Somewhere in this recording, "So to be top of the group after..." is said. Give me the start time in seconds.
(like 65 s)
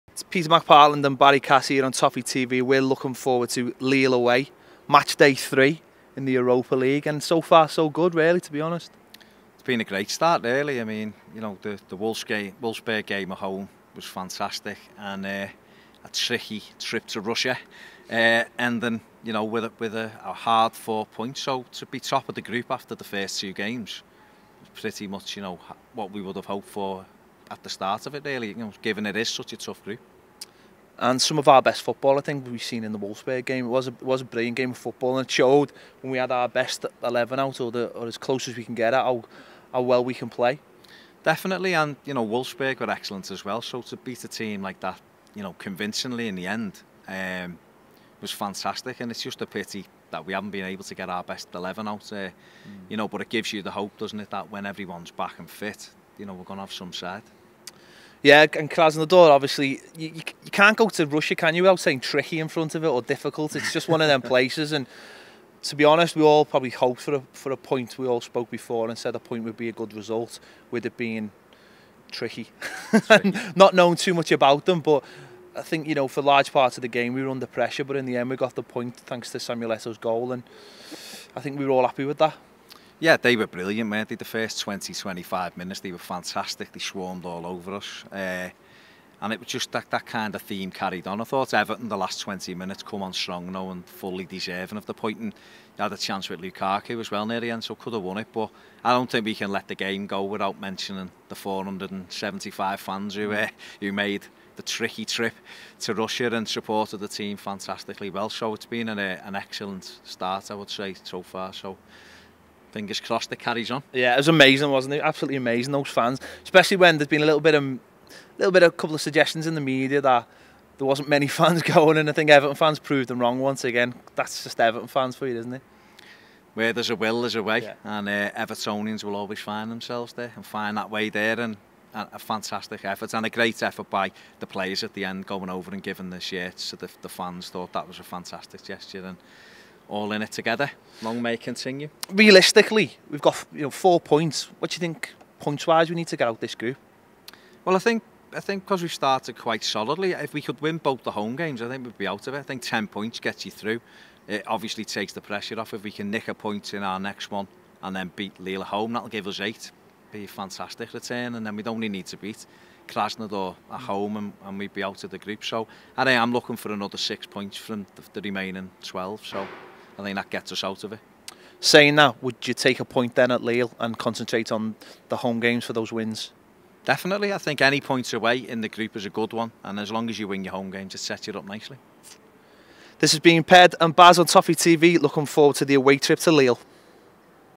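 21 s.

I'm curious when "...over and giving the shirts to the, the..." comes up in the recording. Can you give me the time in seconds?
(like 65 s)
135 s.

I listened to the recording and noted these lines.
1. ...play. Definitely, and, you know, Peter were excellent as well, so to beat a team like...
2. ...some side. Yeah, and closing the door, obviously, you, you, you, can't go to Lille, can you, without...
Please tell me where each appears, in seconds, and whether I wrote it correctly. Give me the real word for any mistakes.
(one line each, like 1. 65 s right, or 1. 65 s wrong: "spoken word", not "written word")
1. 40 s wrong: "Wolfsburg", not "Peter"
2. 56 s wrong: "Russia", not "Lille".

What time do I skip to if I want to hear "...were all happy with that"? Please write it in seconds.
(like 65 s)
81 s.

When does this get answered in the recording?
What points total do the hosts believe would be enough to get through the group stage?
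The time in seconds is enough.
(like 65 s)
152 s.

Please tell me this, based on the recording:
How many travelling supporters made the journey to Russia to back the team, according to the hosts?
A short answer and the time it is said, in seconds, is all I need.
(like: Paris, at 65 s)
475, at 101 s.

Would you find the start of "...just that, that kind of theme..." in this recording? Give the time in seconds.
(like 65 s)
89 s.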